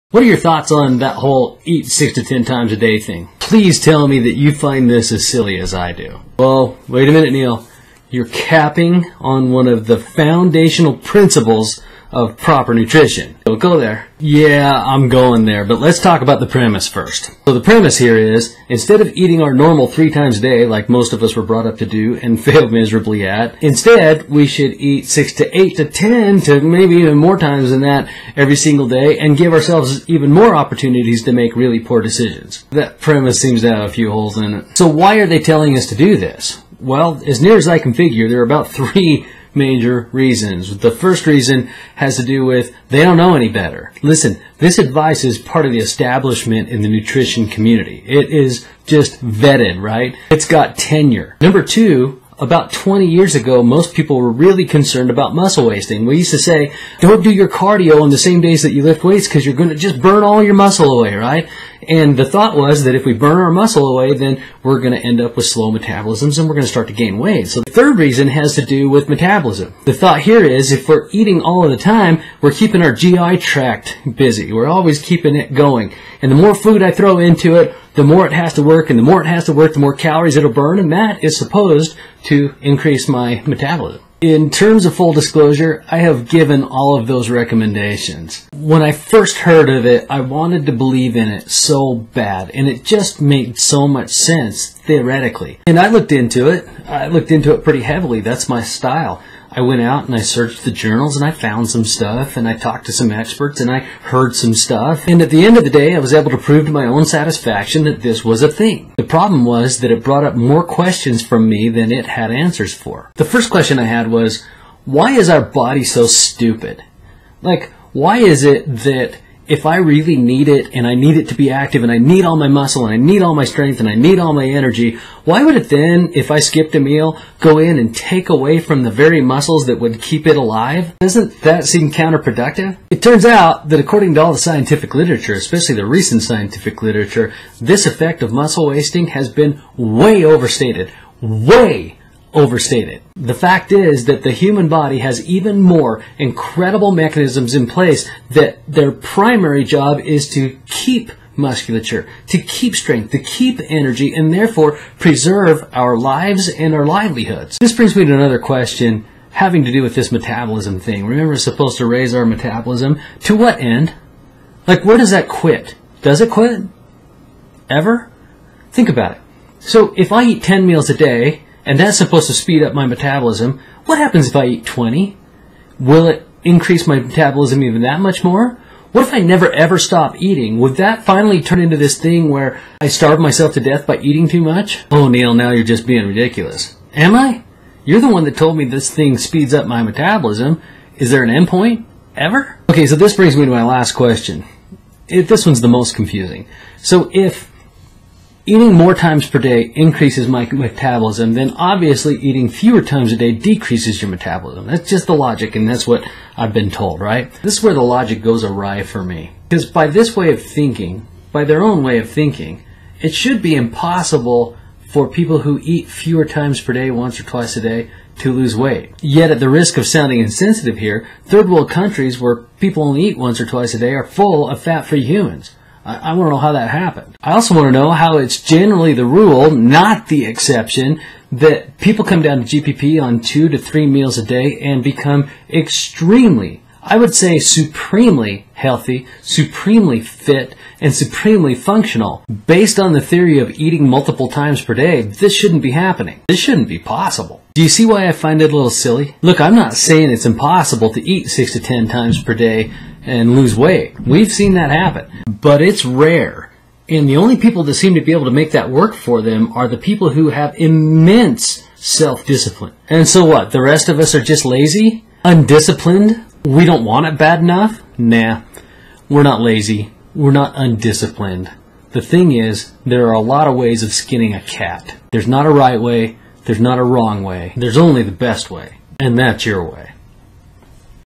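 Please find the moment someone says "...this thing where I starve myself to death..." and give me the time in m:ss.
3:01.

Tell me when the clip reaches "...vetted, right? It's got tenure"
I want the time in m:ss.
0:49.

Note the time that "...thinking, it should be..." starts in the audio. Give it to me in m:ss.
3:32.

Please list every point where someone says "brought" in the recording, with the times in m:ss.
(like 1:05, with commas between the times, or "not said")
0:21, 1:50.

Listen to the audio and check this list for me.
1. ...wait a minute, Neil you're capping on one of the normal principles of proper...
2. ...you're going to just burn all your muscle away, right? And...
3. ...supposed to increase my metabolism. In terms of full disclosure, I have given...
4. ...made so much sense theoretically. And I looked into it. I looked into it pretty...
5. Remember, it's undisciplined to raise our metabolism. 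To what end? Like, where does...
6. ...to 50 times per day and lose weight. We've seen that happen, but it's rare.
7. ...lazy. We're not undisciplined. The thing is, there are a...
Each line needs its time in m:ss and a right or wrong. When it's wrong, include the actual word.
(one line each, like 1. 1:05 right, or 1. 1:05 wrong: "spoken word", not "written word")
1. 0:06 wrong: "foundational", not "normal"
2. 0:59 right
3. 1:21 right
4. 1:33 right
5. 2:41 wrong: "supposed", not "undisciplined"
6. 4:11 wrong: "10", not "50"
7. 4:29 right.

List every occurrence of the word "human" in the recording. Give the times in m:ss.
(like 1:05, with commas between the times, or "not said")
2:24, 3:45.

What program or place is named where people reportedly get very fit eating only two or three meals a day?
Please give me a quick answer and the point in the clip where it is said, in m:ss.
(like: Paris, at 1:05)
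GPP, at 3:52.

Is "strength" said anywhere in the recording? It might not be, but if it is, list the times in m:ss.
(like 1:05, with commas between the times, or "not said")
2:03, 2:32.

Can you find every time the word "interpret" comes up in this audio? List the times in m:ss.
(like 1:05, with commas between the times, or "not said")
not said.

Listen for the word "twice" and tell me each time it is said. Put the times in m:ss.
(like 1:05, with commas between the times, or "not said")
3:37, 3:43.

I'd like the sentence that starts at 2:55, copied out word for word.
Will it increase my metabolism even that much more?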